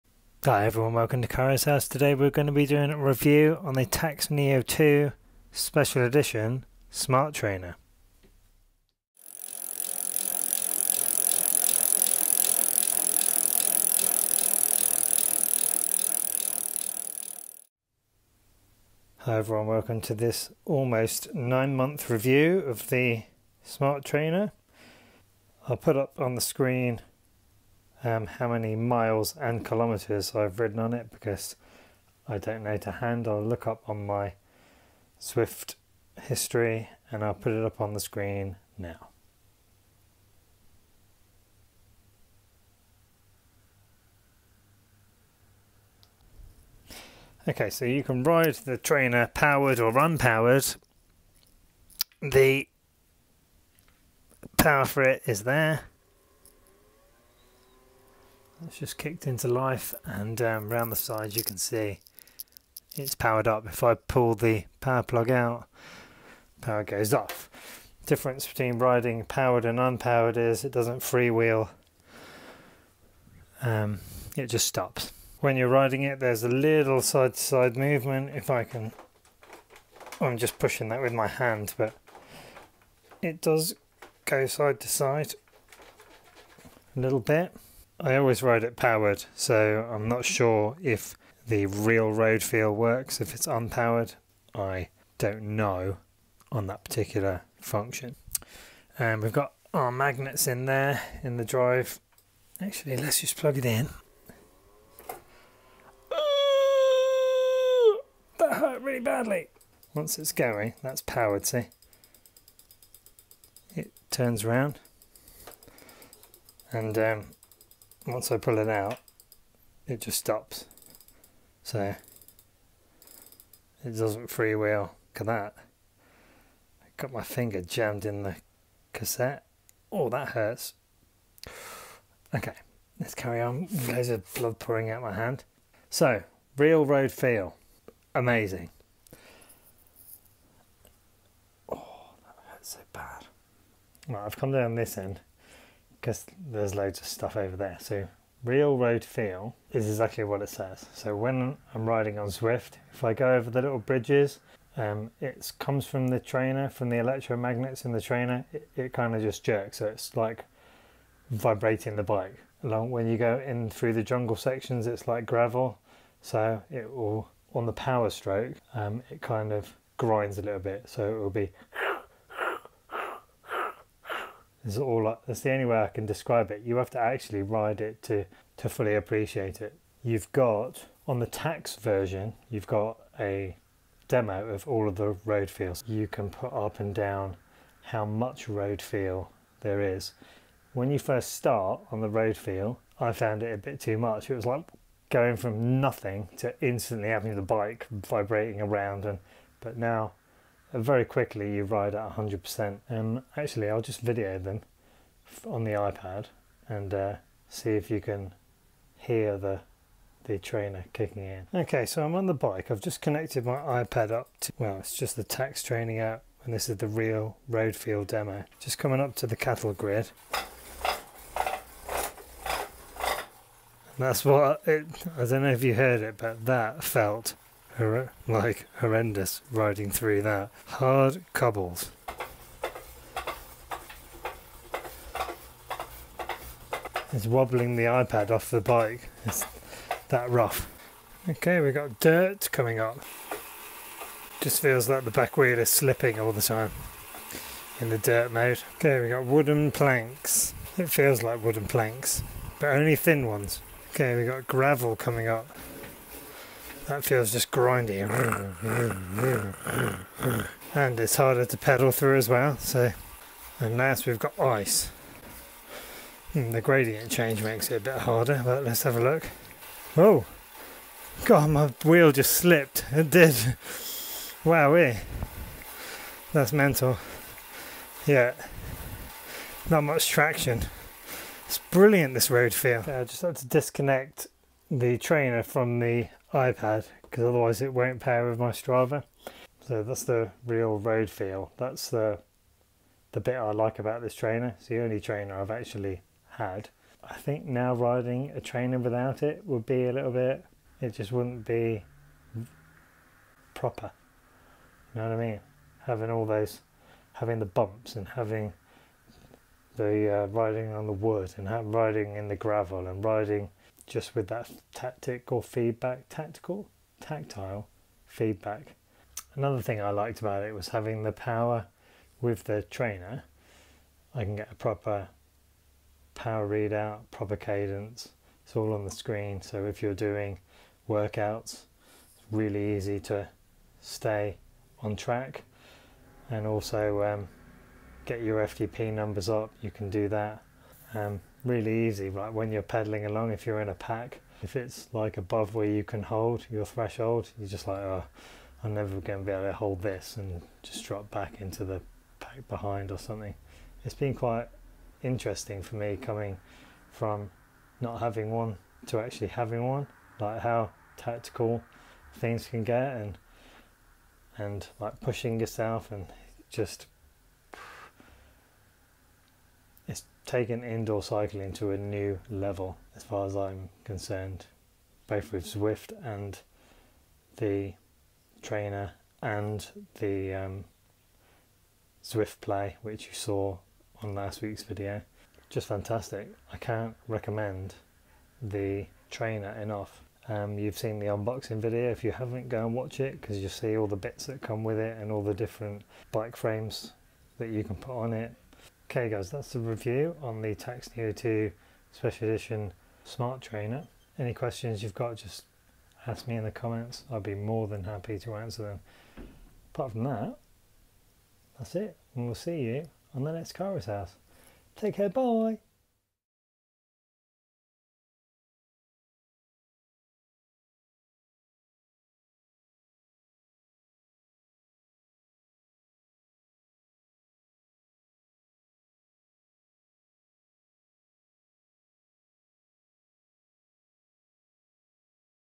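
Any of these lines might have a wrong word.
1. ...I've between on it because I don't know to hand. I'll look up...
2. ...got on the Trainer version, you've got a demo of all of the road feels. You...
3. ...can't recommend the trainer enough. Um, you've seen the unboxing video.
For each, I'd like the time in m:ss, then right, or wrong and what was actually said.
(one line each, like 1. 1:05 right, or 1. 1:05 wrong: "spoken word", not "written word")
1. 0:30 wrong: "ridden", not "between"
2. 3:00 wrong: "Tacx", not "Trainer"
3. 6:26 right.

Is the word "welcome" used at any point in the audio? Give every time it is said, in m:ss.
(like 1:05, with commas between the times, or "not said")
0:00, 0:19.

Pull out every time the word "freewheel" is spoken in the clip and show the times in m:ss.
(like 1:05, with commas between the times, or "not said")
1:10, 2:04.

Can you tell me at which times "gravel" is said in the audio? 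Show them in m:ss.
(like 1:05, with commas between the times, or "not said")
2:45, 4:14, 5:12.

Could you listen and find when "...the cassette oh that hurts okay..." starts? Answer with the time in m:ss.
2:08.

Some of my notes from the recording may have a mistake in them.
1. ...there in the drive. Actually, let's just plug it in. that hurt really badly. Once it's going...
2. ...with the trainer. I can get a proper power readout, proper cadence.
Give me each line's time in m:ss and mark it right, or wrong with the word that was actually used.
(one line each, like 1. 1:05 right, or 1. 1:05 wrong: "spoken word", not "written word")
1. 1:40 right
2. 5:22 right.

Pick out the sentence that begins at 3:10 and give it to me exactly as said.
When you first start on the road feel, I found it a bit too much.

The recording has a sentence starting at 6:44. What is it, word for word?
Any questions you've got, just ask me in the comments.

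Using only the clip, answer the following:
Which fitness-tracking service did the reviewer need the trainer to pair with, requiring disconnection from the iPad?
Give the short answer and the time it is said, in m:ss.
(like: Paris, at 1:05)
Strava, at 4:48.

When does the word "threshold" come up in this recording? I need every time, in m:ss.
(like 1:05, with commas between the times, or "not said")
5:46.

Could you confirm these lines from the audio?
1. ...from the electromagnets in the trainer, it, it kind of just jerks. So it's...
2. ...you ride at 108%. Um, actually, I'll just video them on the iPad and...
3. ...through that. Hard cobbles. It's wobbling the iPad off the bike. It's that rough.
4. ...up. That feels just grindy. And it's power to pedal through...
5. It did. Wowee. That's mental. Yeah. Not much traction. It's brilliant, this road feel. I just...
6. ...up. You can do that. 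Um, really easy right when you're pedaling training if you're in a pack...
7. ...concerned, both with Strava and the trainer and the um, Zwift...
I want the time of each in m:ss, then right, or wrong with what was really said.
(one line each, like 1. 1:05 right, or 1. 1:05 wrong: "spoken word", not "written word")
1. 2:36 right
2. 3:21 wrong: "100", not "108"
3. 3:49 right
4. 4:15 wrong: "harder", not "power"
5. 4:32 right
6. 5:39 wrong: "along", not "training"
7. 6:13 wrong: "Zwift", not "Strava".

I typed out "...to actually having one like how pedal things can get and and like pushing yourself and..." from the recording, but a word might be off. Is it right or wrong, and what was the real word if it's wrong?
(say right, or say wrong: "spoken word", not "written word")
wrong: "tactical", not "pedal".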